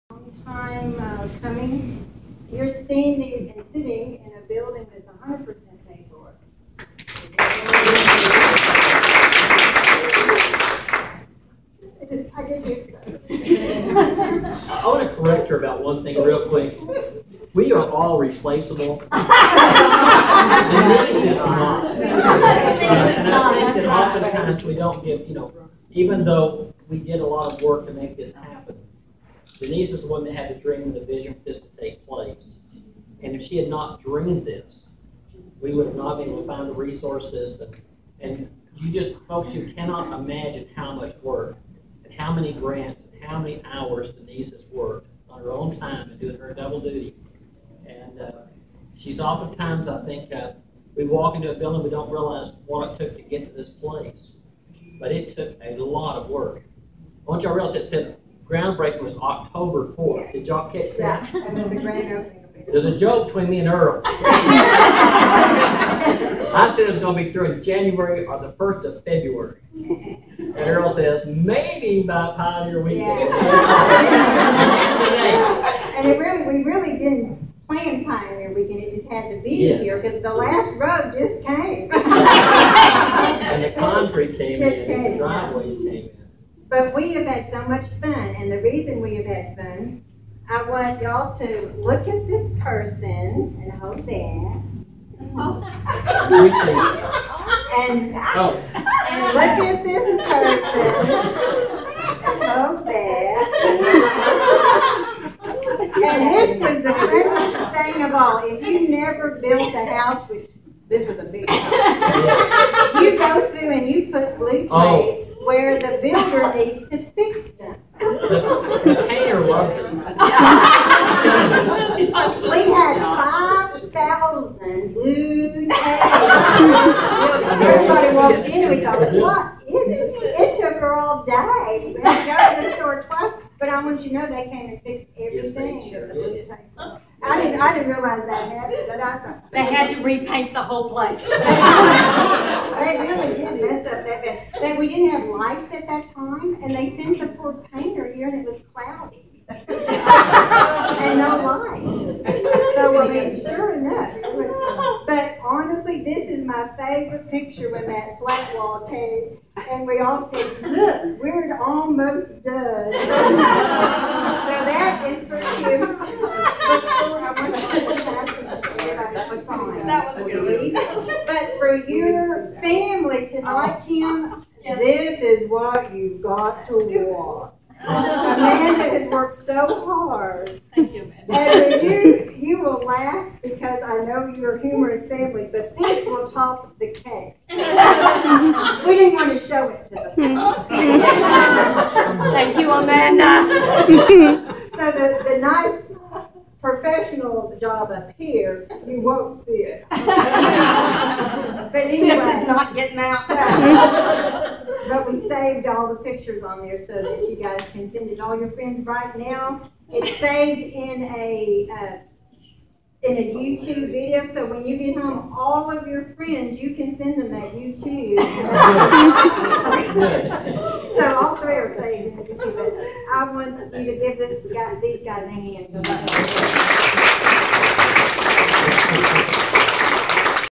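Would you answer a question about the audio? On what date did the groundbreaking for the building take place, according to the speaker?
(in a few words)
October 4th.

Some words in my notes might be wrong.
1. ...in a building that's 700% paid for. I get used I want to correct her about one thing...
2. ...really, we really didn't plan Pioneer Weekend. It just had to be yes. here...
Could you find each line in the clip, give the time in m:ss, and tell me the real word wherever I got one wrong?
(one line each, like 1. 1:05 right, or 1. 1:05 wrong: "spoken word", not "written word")
1. 0:04 wrong: "100", not "700"
2. 1:16 right.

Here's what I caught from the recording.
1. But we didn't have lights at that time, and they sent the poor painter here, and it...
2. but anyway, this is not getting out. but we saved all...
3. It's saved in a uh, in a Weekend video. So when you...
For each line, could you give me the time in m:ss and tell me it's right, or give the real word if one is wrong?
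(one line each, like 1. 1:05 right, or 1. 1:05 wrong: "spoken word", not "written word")
1. 2:24 right
2. 3:19 right
3. 3:29 wrong: "YouTube", not "Weekend".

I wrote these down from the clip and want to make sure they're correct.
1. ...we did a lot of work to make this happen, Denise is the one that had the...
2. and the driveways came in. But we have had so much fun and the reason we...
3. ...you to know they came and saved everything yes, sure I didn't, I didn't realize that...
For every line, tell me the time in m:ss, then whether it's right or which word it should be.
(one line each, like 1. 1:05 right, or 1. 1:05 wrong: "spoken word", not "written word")
1. 0:26 right
2. 1:25 right
3. 2:14 wrong: "fixed", not "saved".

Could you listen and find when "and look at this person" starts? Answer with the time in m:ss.
1:39.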